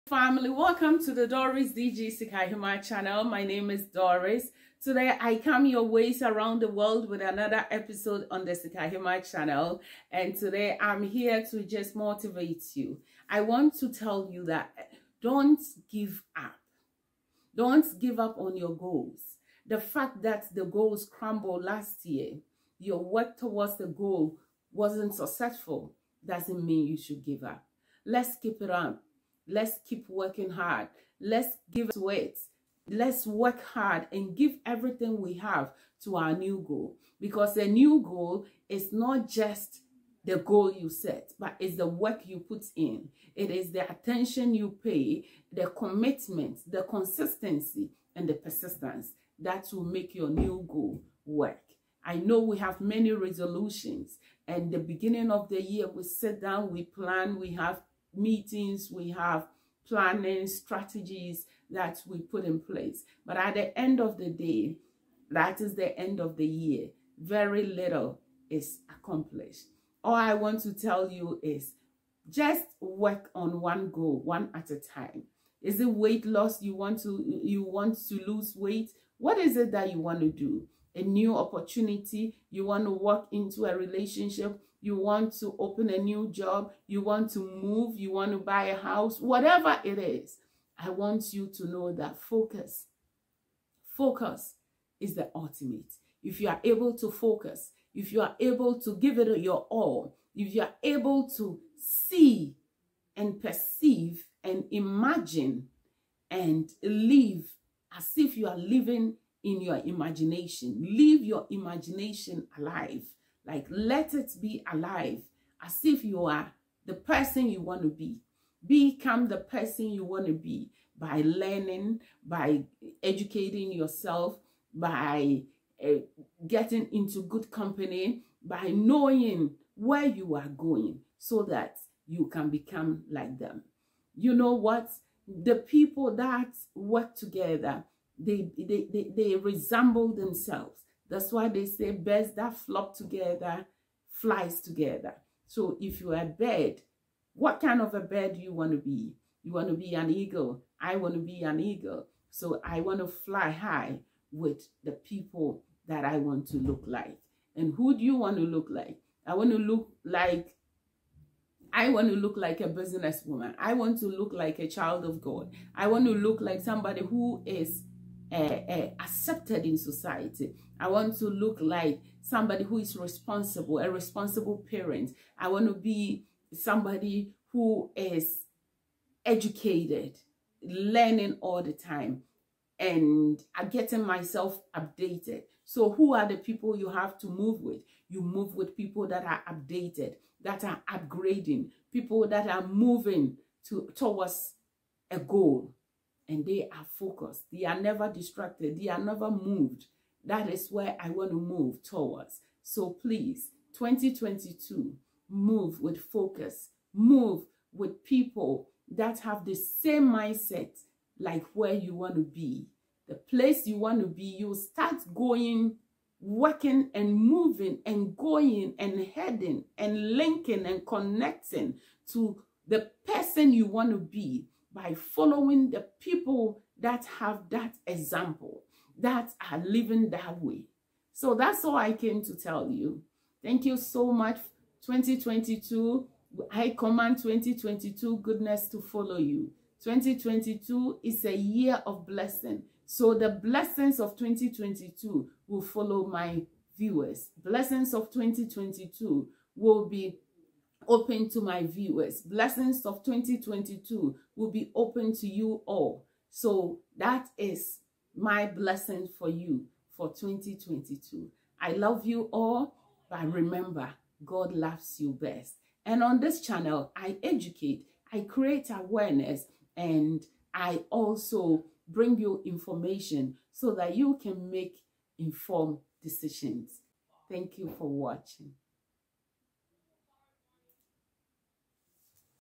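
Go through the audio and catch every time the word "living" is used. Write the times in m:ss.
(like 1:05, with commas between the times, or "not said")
1:48, 3:49.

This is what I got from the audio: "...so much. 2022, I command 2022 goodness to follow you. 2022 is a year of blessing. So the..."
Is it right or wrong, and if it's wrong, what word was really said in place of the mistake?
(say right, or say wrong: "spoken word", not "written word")
right.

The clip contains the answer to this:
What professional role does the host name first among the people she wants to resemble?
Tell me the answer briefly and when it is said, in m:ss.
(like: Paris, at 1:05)
businesswoman, at 2:42.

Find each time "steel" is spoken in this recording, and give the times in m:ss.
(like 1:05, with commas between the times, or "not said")
not said.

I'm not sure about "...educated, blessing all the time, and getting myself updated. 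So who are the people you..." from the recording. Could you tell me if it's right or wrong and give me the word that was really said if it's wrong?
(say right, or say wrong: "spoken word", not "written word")
wrong: "learning", not "blessing".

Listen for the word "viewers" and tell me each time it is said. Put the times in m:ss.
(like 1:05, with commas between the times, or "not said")
4:06, 4:11.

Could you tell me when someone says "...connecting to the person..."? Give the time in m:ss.
3:40.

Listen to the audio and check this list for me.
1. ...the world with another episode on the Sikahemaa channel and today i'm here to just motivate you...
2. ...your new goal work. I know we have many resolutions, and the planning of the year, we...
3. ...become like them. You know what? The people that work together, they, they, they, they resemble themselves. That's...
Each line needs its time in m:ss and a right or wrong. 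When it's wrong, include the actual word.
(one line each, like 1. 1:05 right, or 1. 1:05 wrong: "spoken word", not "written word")
1. 0:06 right
2. 0:50 wrong: "beginning", not "planning"
3. 2:12 right.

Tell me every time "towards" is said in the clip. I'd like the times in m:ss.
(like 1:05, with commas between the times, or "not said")
0:23, 3:13, 3:21.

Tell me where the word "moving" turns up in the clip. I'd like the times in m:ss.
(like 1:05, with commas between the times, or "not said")
3:12, 3:37.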